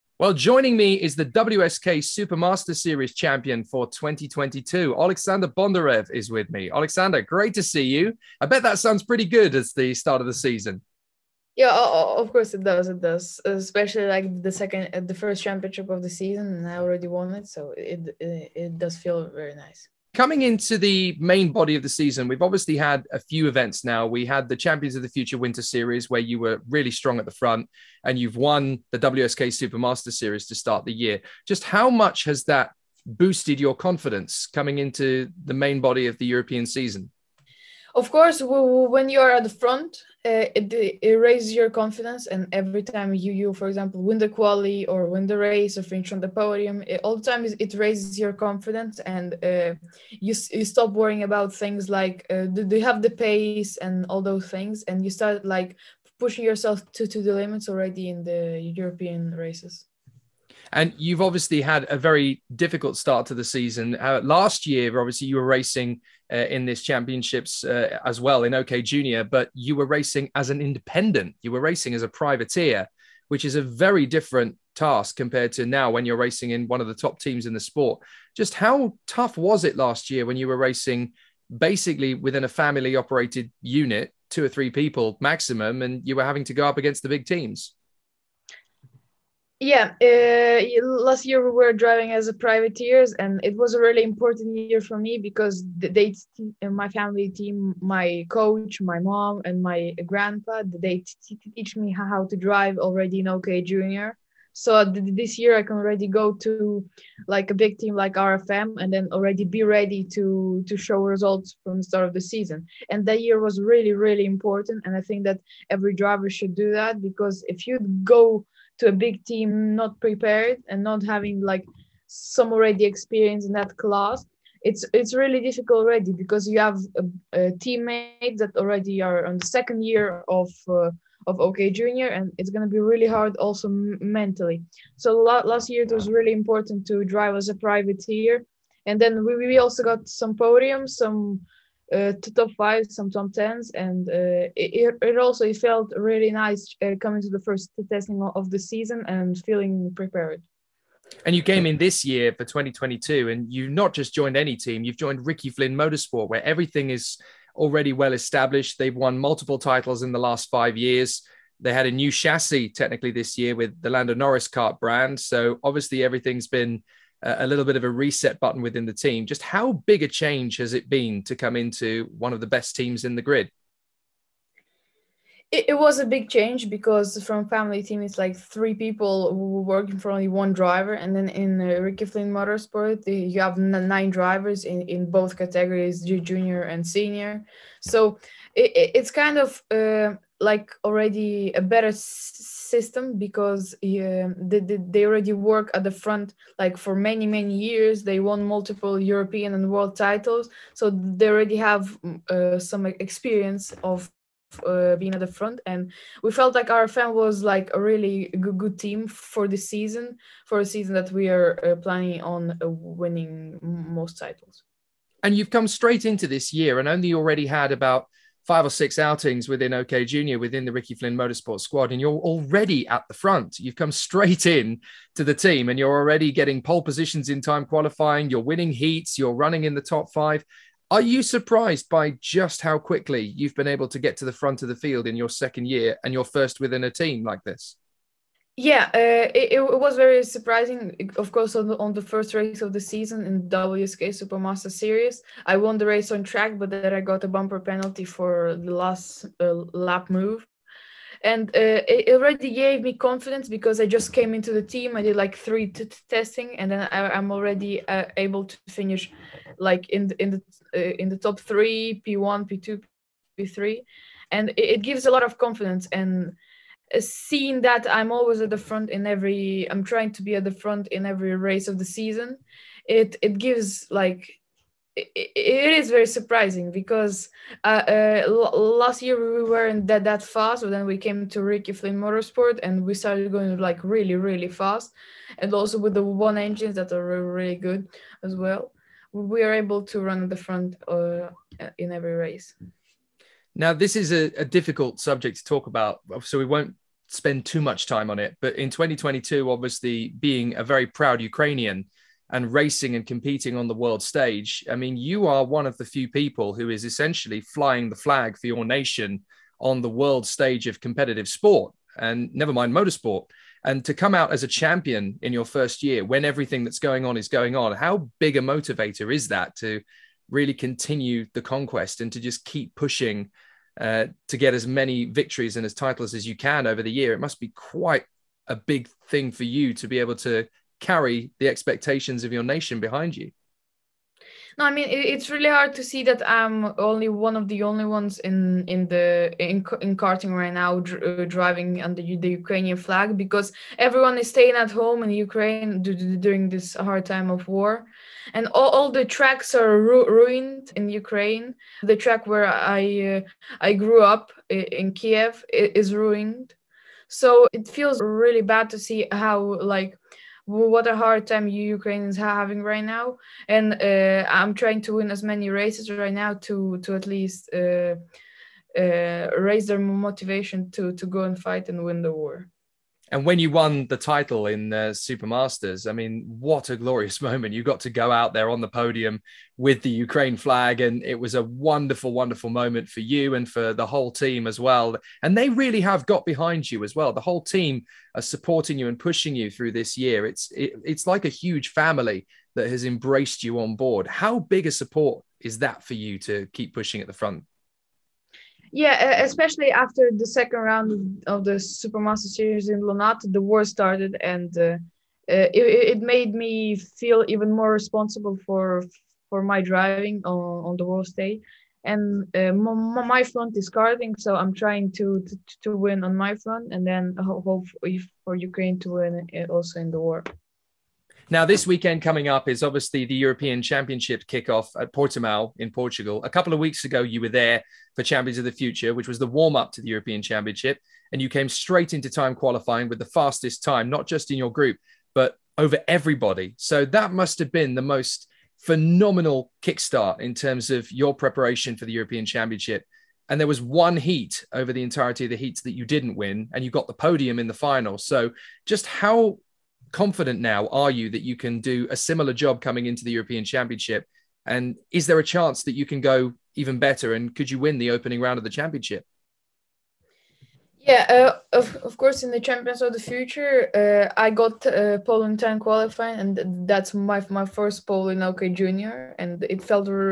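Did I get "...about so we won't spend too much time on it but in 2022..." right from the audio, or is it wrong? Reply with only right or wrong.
right.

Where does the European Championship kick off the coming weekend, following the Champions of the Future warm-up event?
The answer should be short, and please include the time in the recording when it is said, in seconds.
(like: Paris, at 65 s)
Portimao, at 424 s.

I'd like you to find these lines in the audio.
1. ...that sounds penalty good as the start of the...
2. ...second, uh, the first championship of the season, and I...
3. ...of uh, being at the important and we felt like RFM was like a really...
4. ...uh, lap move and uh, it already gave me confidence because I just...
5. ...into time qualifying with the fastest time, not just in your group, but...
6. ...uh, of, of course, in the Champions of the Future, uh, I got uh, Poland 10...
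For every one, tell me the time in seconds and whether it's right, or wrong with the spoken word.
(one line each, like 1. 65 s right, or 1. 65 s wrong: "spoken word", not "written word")
1. 8 s wrong: "pretty", not "penalty"
2. 14 s right
3. 203 s wrong: "front", not "important"
4. 249 s right
5. 431 s right
6. 461 s right.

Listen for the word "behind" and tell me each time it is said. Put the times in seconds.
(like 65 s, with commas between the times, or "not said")
332 s, 386 s.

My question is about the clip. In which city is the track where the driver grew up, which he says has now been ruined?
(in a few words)
Kiev.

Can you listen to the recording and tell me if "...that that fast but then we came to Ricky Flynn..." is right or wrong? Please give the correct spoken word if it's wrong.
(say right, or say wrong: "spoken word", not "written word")
right.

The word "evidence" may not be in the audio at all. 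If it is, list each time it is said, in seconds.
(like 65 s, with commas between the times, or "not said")
not said.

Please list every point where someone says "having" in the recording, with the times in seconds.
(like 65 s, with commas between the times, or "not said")
86 s, 121 s, 362 s.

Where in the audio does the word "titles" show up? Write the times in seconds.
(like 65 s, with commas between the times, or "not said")
159 s, 199 s, 214 s, 325 s, 373 s.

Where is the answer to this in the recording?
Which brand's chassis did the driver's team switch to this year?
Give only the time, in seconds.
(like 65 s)
163 s.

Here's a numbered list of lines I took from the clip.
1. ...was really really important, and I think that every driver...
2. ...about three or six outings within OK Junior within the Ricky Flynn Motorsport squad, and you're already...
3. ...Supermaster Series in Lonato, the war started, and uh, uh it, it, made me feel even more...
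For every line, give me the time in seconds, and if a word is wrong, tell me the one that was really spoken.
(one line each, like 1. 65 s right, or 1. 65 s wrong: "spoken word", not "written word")
1. 113 s right
2. 217 s wrong: "five", not "three"
3. 401 s right.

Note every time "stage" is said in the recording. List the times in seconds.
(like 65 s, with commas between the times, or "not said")
304 s, 310 s, 411 s.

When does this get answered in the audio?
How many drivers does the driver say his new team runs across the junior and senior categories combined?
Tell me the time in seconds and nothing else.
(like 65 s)
183 s.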